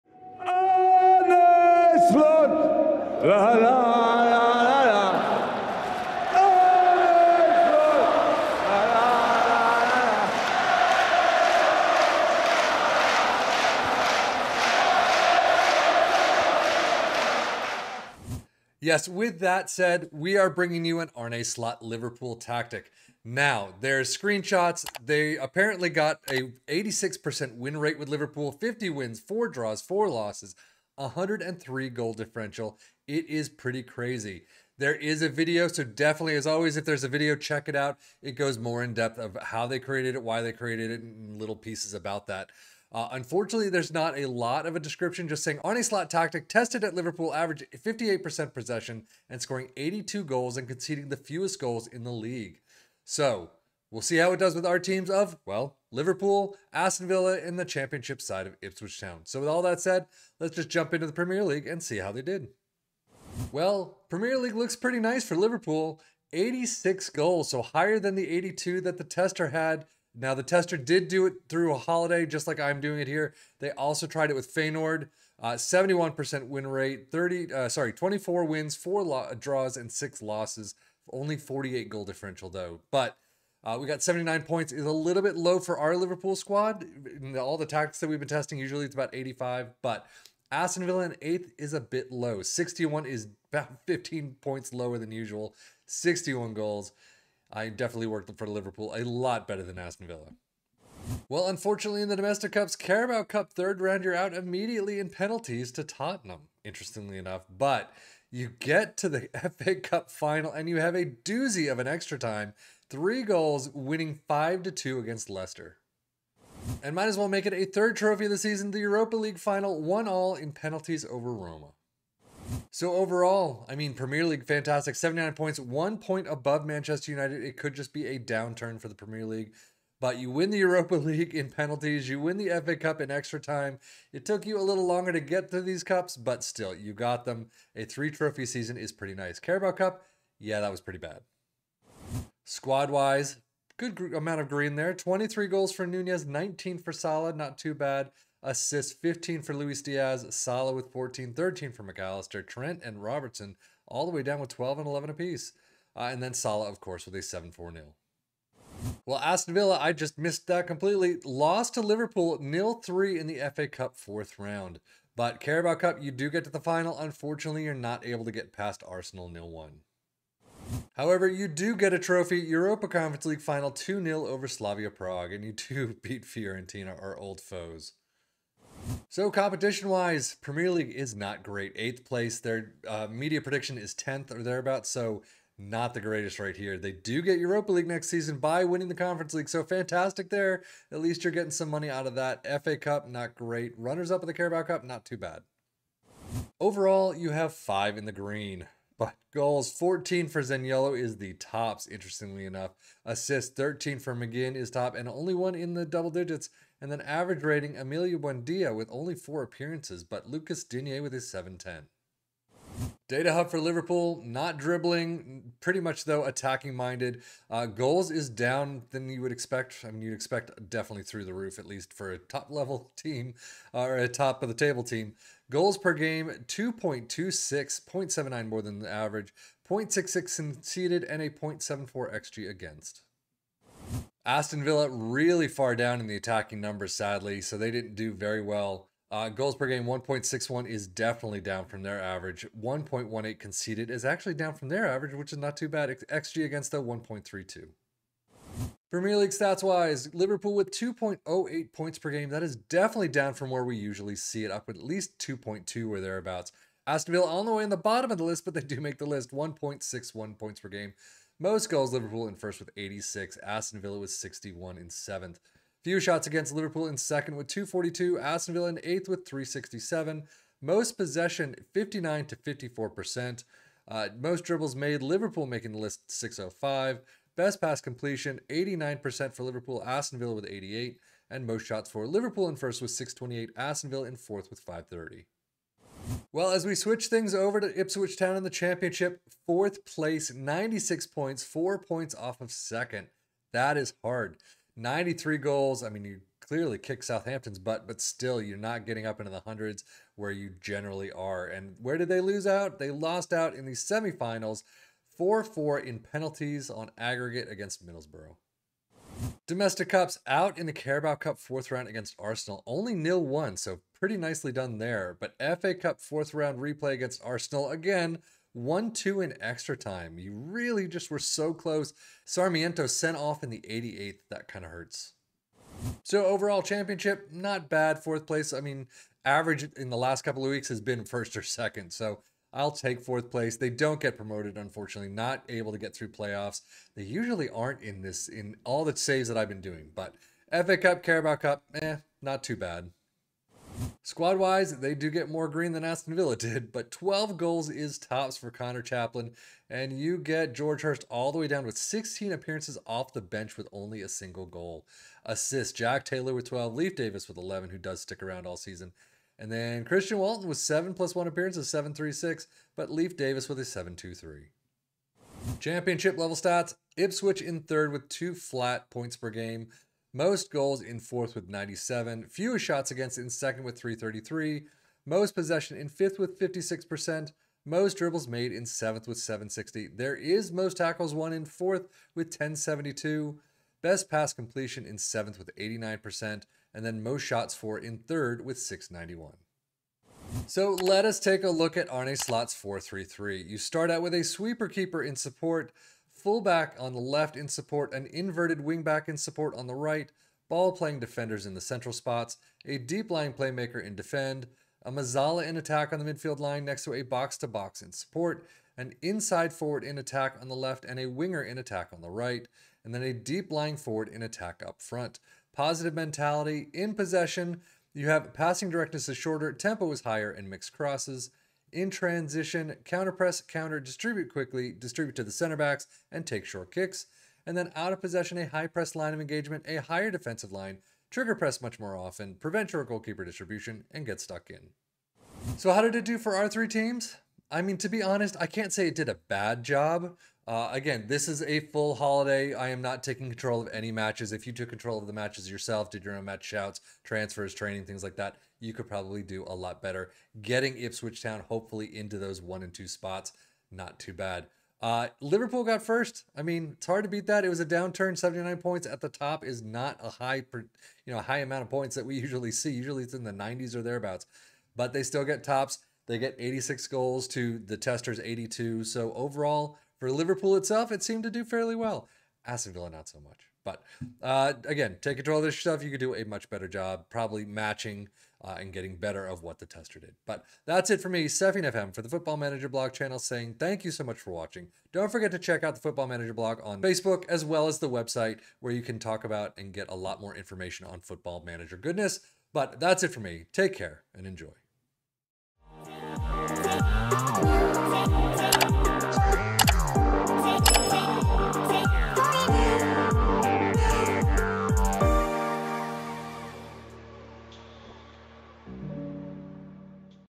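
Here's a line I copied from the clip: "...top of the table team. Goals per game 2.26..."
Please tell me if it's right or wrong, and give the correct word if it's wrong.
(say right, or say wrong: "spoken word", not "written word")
right.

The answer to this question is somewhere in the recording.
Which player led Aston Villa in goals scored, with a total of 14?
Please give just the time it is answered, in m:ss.
3:20.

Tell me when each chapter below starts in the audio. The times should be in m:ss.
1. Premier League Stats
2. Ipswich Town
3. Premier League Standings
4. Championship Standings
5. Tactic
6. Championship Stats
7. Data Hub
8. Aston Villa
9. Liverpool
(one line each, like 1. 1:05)
1. 4:08
2. 5:09
3. 1:03
4. 4:46
5. 6:30
6. 6:05
7. 3:32
8. 2:38
9. 1:40.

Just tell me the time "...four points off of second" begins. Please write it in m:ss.
4:51.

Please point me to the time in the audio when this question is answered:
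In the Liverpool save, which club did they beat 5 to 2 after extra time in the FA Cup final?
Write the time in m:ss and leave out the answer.
1:55.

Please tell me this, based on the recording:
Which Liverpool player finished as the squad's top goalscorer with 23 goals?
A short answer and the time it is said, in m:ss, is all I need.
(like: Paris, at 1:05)
Nunez, at 2:25.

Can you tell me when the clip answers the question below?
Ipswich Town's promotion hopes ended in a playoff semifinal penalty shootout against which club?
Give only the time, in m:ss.
5:07.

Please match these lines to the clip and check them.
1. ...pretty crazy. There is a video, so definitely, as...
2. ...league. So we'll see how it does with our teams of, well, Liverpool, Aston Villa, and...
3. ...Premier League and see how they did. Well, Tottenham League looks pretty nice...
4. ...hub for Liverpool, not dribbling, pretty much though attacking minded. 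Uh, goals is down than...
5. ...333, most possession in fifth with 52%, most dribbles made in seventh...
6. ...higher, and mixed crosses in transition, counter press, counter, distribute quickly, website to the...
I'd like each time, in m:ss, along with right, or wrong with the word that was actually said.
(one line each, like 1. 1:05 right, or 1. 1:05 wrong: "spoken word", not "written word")
1. 0:33 right
2. 0:52 right
3. 1:01 wrong: "Premier", not "Tottenham"
4. 3:33 right
5. 6:13 wrong: "56", not "52"
6. 7:00 wrong: "distribute", not "website".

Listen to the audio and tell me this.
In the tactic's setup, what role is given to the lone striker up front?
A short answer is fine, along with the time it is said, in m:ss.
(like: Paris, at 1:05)
Deep lying forward, at 6:53.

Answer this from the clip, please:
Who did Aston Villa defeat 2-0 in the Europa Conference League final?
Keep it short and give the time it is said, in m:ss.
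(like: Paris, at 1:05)
Slavia Prague, at 2:54.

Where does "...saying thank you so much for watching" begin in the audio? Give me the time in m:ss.
8:03.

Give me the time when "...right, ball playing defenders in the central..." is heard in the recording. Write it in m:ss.
6:39.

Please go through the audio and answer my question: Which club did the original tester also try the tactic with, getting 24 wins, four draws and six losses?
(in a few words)
Feyenoord.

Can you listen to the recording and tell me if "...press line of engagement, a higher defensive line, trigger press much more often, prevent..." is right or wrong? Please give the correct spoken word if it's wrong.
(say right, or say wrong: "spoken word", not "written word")
right.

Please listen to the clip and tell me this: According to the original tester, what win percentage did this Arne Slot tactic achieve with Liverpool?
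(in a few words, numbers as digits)
86%.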